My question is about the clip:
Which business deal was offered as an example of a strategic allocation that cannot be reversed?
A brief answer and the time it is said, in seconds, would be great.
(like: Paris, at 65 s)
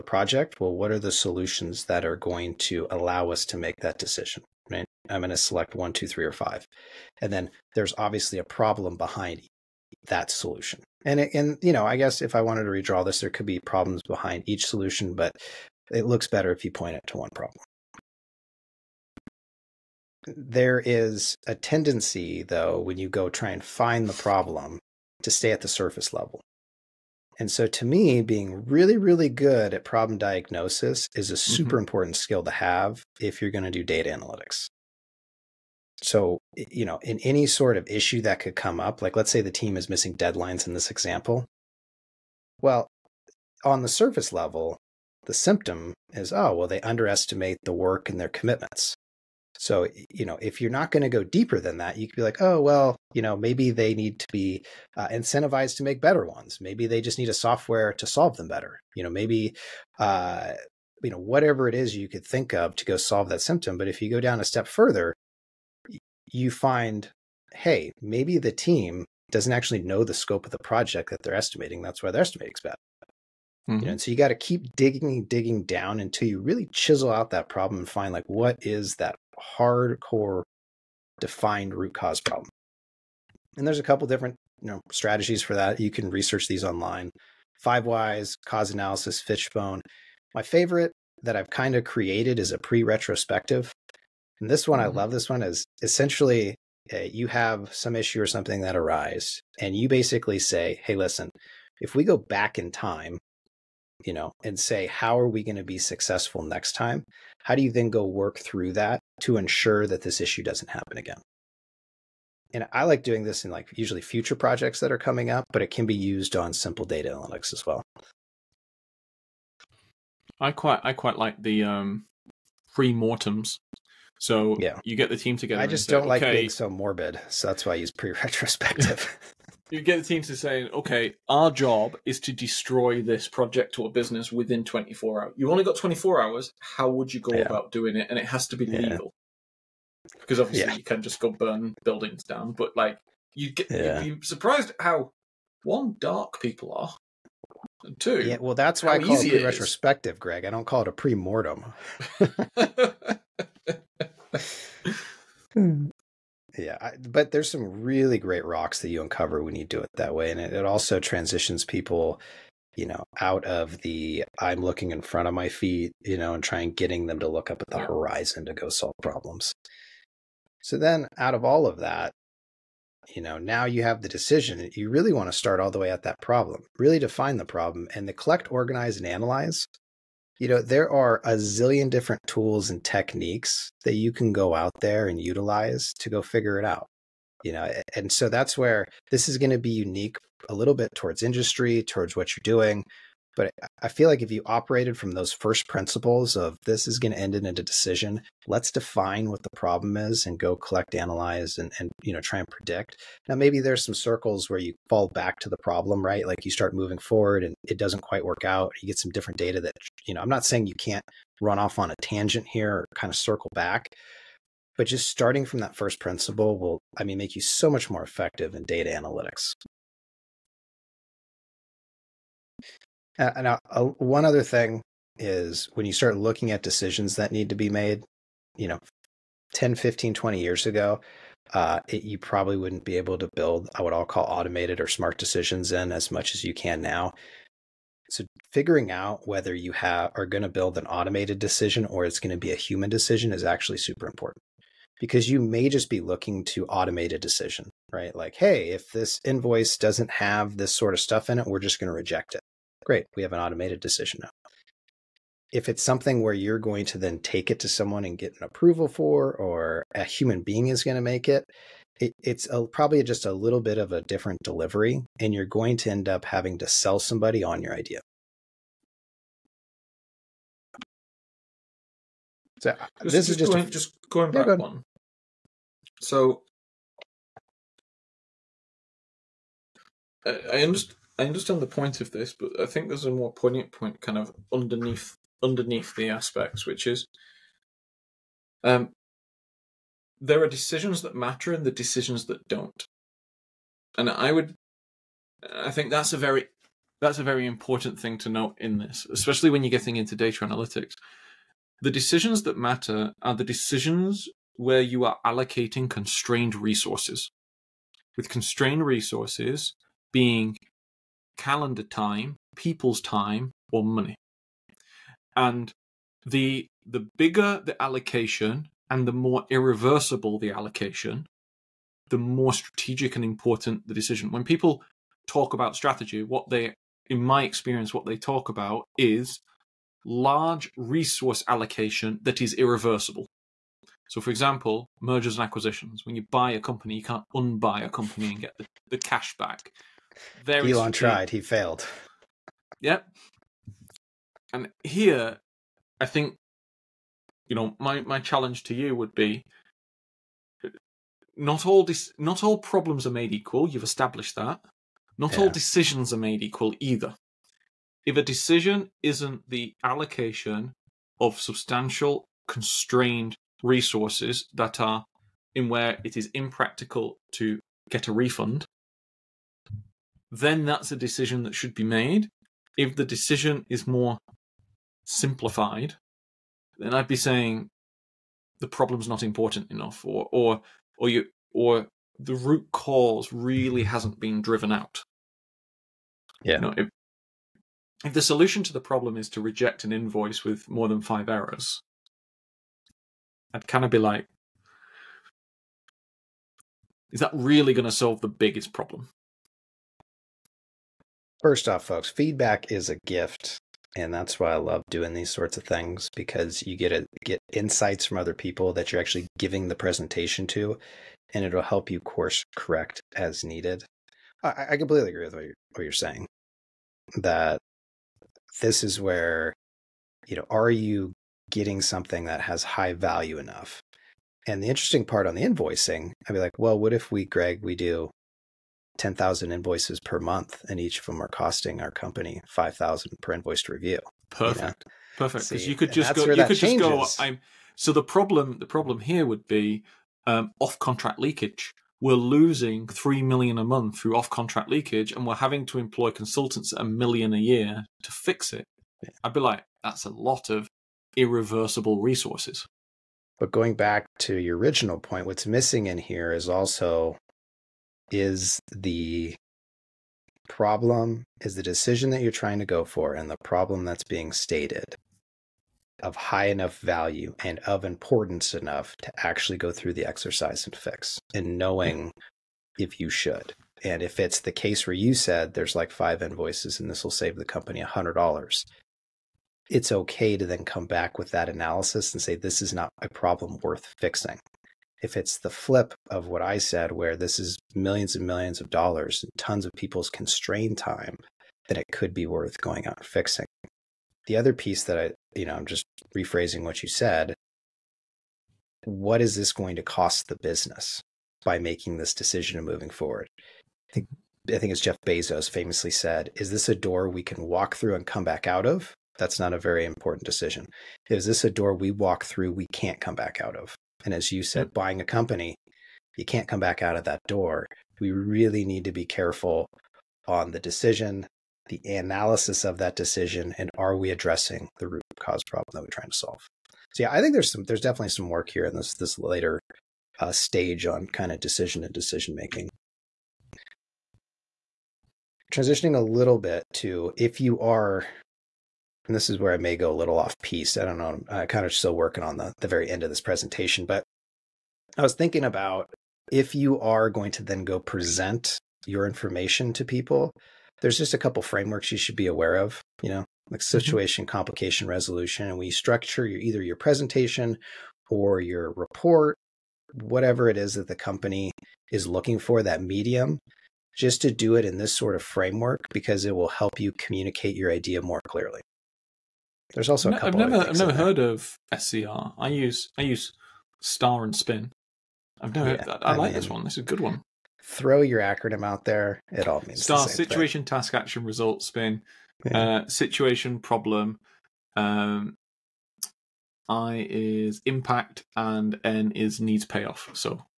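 mergers and acquisitions, at 335 s.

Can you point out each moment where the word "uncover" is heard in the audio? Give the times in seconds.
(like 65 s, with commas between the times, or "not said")
159 s.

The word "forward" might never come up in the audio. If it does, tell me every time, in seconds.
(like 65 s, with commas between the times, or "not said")
206 s, 502 s.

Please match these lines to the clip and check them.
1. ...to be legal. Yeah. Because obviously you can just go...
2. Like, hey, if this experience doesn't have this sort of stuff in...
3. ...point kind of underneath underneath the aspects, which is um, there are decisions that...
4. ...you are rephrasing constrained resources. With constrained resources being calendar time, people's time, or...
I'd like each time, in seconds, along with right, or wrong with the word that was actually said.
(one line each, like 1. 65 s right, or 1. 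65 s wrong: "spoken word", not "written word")
1. 138 s right
2. 248 s wrong: "invoice", not "experience"
3. 283 s right
4. 304 s wrong: "allocating", not "rephrasing".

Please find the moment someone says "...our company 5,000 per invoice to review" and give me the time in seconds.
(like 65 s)
431 s.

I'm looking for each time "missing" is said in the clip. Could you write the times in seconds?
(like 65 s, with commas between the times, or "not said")
39 s, 455 s.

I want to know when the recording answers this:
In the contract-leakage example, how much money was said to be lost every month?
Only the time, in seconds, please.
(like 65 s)
442 s.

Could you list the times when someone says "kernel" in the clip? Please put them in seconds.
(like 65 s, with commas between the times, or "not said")
not said.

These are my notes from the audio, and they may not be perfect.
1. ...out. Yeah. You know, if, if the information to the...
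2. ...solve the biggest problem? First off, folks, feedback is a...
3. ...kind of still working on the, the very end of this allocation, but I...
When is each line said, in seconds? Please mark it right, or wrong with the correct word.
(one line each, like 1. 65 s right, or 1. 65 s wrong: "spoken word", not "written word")
1. 384 s wrong: "solution", not "information"
2. 397 s right
3. 541 s wrong: "presentation", not "allocation".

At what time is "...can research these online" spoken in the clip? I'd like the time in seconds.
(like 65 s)
85 s.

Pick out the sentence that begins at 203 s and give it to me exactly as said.
Now maybe there's some circles where you fall back to the problem, right?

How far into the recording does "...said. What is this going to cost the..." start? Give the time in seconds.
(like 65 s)
496 s.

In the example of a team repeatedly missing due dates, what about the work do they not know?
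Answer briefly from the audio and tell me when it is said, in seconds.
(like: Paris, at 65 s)
the scope of the project, at 70 s.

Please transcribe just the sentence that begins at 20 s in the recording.
There is a tendency, though, when you go try and find the problem, to stay at the surface level.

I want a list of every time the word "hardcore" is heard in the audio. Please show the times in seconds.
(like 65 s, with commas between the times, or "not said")
79 s.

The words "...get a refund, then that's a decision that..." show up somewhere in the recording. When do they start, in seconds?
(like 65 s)
367 s.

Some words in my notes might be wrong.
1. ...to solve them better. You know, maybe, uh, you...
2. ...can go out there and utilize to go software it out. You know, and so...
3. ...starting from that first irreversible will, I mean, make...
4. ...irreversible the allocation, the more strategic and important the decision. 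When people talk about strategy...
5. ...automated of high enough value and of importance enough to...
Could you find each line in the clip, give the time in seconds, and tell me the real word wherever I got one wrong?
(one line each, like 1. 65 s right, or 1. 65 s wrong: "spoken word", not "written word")
1. 57 s right
2. 184 s wrong: "figure", not "software"
3. 215 s wrong: "principle", not "irreversible"
4. 319 s right
5. 464 s wrong: "stated", not "automated".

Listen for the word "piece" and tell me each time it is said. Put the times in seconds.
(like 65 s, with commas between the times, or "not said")
494 s, 540 s.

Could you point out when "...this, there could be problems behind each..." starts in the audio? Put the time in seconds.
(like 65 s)
13 s.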